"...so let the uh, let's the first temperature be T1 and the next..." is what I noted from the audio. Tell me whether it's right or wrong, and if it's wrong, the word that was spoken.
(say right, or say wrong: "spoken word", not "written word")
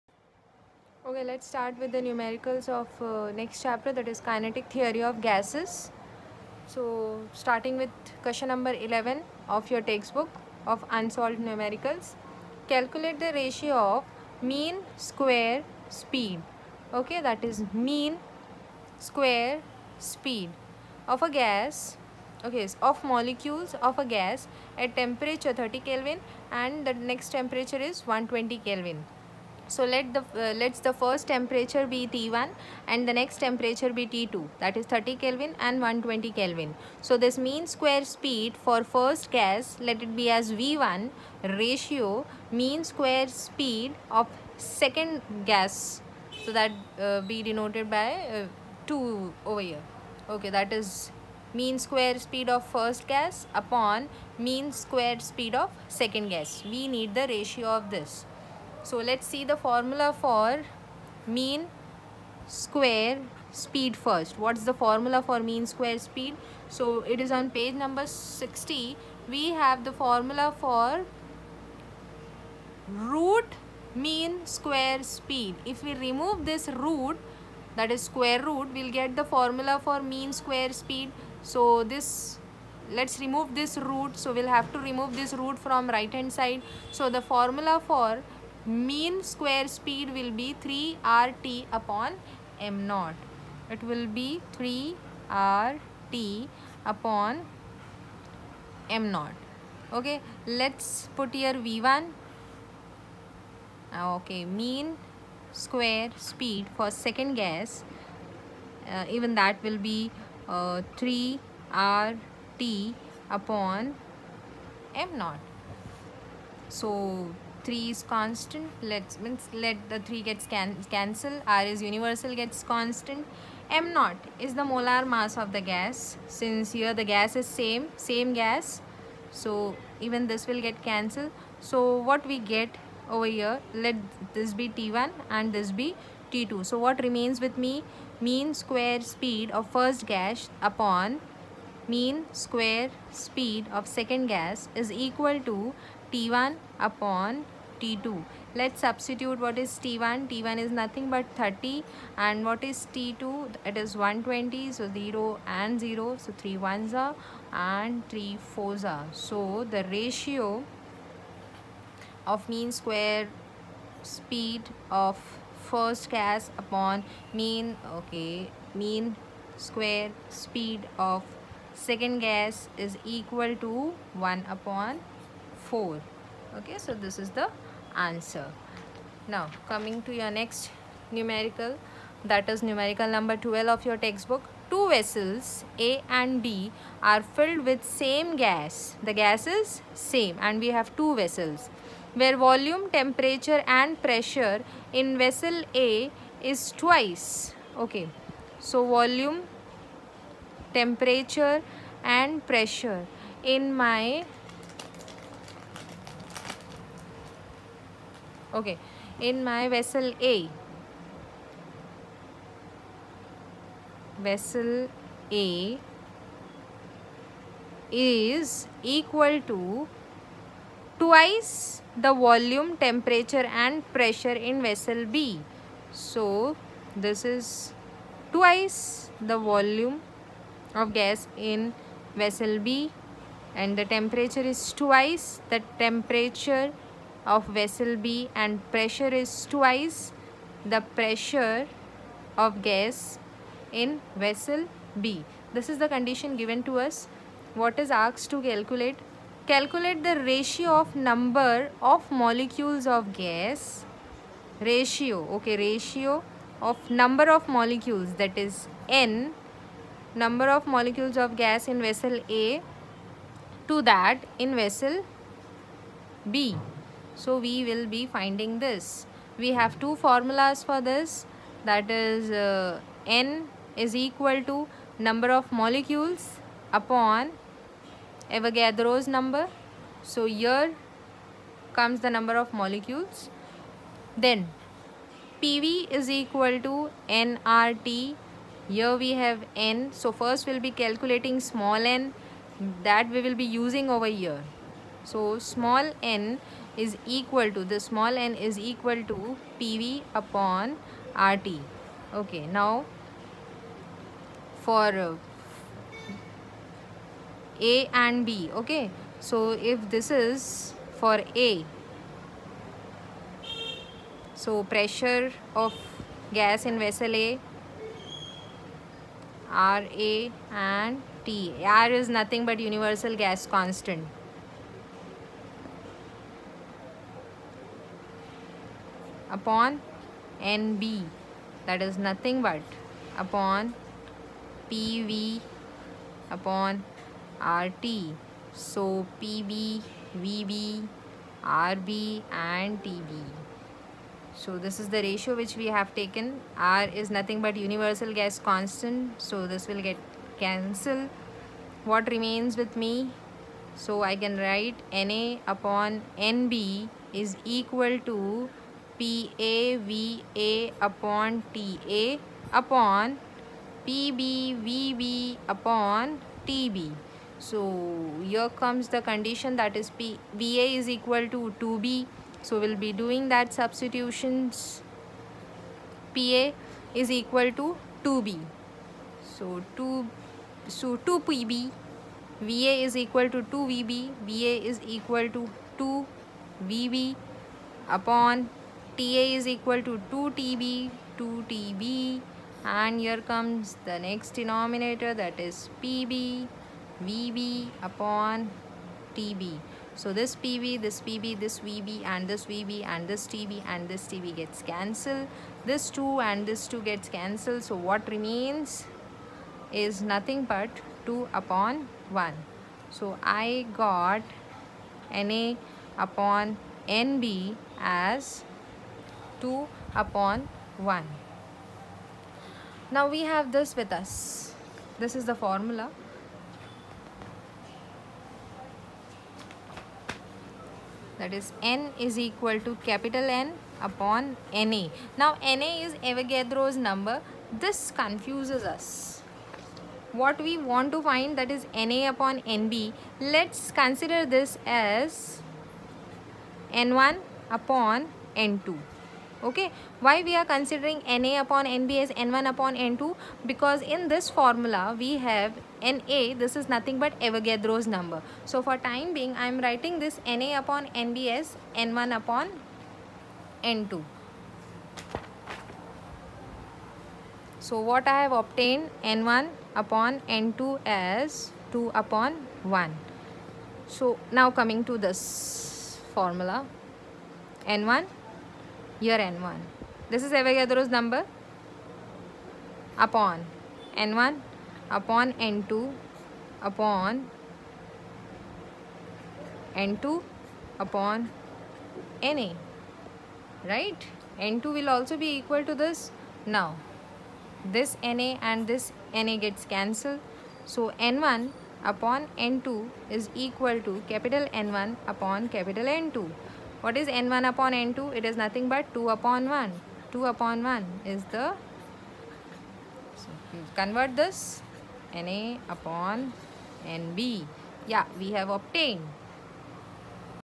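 right.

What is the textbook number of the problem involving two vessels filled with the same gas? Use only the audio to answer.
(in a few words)
12.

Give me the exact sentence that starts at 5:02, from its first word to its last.
Okay, now for uh, A and B, okay.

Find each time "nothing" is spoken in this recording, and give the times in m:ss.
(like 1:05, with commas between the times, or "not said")
2:30, 5:22, 5:31, 5:47, 6:50, 7:36, 8:28.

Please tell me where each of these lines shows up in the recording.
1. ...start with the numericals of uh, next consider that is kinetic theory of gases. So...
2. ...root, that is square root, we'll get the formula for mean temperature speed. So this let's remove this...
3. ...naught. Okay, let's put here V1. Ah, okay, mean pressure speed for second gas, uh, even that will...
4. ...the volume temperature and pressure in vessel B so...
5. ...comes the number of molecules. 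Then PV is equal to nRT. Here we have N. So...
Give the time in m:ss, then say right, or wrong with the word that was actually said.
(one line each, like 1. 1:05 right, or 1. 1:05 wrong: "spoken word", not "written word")
1. 0:01 wrong: "chapter", not "consider"
2. 1:16 wrong: "square", not "temperature"
3. 1:39 wrong: "square", not "pressure"
4. 3:41 right
5. 4:41 right.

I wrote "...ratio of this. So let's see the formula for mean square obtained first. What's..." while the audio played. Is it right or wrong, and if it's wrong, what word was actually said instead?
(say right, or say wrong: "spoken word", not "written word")
wrong: "speed", not "obtained".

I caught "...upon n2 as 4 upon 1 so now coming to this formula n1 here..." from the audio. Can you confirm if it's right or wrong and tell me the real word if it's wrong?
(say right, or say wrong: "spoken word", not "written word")
wrong: "2", not "4".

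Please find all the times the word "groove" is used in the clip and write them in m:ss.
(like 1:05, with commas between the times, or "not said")
not said.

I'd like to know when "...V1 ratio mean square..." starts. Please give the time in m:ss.
0:40.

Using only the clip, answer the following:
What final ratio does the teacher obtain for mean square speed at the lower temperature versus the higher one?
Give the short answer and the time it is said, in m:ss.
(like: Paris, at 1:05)
1 upon 4, at 2:54.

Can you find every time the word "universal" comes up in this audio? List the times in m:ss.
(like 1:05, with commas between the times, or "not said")
2:01, 5:22, 5:47.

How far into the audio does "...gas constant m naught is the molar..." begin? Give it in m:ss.
2:02.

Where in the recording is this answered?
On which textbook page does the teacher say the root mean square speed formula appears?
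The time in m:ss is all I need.
1:07.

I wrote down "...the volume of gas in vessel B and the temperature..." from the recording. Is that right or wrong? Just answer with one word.
right.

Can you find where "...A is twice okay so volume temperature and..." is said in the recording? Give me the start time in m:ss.
3:15.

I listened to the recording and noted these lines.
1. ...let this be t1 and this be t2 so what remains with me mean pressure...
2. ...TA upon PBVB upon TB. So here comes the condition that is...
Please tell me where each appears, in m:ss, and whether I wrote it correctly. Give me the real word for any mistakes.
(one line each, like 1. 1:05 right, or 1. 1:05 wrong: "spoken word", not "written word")
1. 2:13 wrong: "square", not "pressure"
2. 6:01 right.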